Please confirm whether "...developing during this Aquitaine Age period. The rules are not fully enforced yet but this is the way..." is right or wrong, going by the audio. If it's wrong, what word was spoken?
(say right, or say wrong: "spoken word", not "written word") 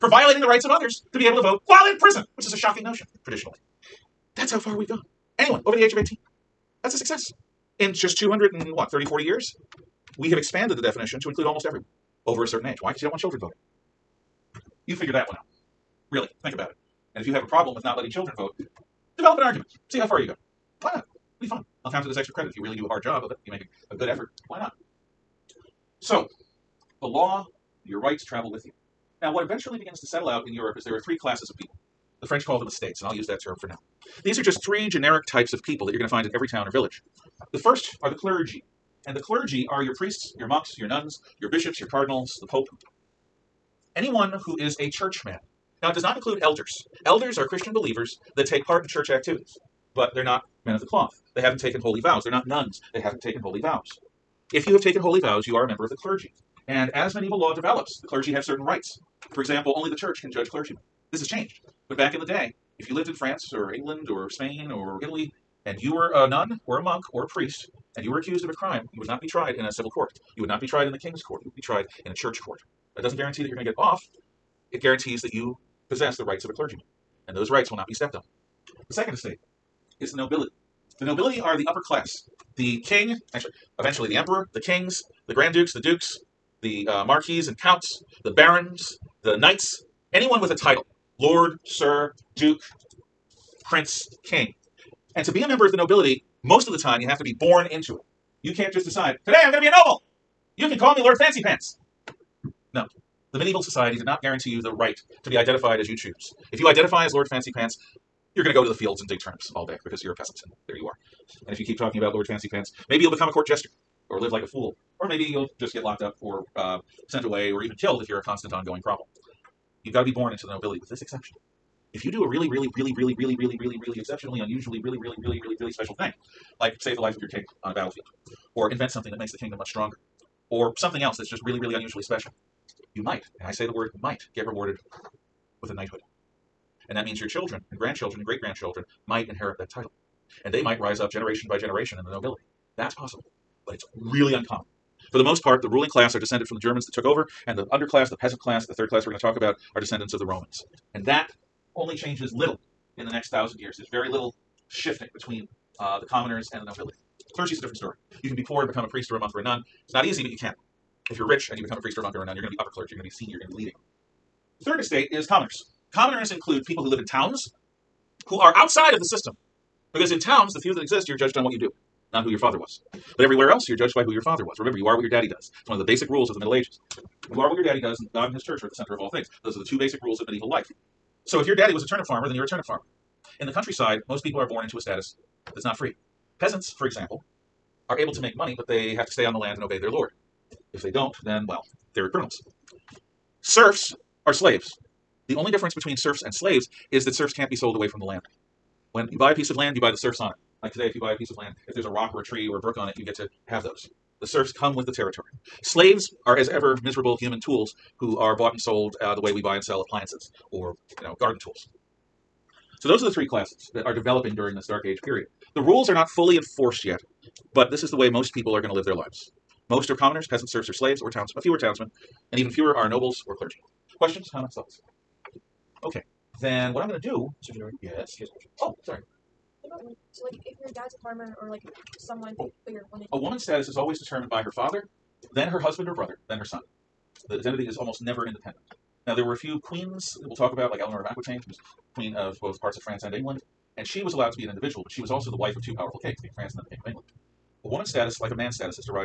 wrong: "Dark", not "Aquitaine".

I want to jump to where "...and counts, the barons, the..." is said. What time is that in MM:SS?
01:27.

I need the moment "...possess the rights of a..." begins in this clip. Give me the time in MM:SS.
01:15.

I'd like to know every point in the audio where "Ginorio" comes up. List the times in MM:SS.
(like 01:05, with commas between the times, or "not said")
03:47.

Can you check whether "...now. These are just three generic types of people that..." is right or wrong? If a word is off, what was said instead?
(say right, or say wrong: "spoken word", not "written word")
right.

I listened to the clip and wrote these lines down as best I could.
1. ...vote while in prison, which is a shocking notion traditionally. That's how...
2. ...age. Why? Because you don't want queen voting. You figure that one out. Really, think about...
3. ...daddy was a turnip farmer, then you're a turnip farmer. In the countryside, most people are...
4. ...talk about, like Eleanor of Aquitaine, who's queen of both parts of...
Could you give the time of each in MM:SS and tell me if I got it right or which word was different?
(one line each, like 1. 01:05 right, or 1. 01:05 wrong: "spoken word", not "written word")
1. 00:01 right
2. 00:12 wrong: "children", not "queen"
3. 03:01 right
4. 04:00 right.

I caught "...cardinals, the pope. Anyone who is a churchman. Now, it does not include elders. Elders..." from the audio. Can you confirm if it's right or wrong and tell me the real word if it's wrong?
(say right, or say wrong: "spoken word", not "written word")
right.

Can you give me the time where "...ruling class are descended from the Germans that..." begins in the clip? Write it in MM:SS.
02:25.